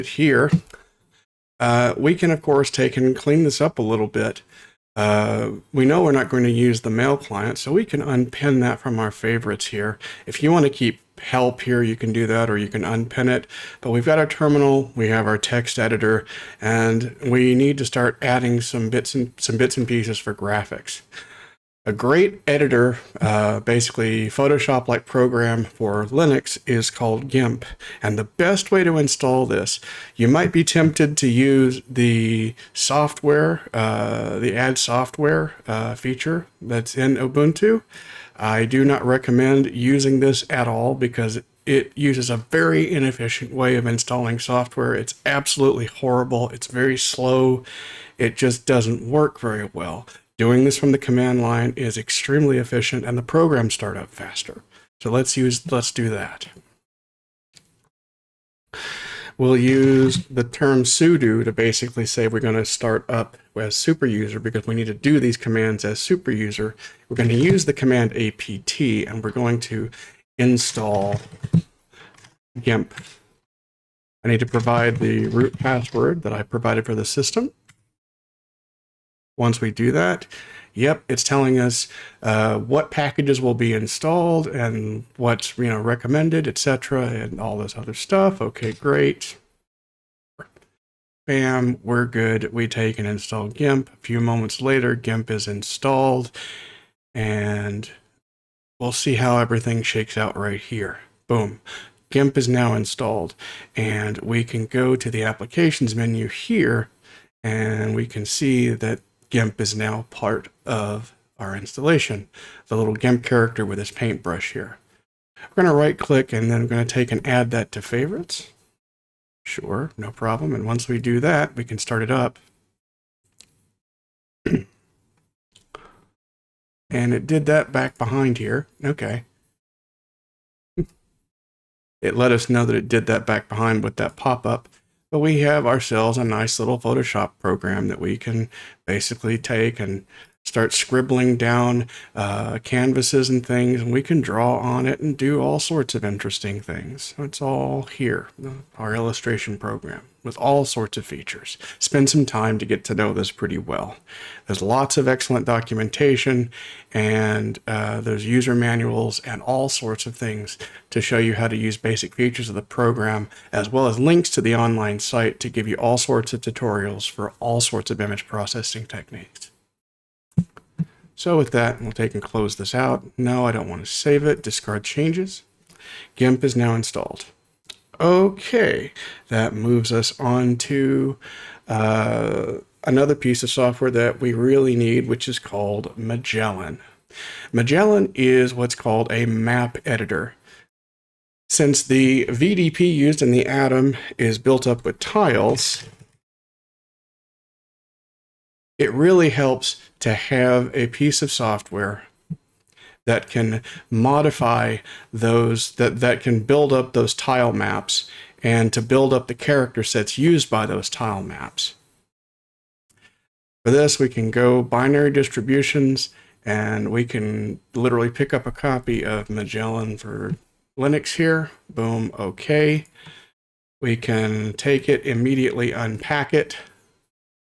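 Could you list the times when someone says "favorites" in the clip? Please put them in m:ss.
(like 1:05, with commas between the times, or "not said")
0:09, 1:57.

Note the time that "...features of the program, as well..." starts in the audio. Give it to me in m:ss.
2:42.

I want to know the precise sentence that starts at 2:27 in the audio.
It's all here, uh, our illustration program with all sorts of features.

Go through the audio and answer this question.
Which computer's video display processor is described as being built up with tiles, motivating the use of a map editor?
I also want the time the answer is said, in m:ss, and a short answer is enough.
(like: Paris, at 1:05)
Adam, at 3:13.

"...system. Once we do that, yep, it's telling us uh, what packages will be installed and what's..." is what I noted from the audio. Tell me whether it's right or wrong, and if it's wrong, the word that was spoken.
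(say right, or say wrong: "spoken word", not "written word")
right.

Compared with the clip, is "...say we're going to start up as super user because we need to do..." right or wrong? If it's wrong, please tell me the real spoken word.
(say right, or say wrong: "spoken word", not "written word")
right.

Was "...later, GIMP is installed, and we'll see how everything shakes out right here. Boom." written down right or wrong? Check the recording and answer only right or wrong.
right.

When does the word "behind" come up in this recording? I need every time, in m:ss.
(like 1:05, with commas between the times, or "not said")
2:07, 2:13.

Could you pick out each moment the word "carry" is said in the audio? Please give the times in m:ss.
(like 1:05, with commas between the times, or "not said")
not said.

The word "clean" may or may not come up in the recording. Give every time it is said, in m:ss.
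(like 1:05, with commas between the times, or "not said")
0:03.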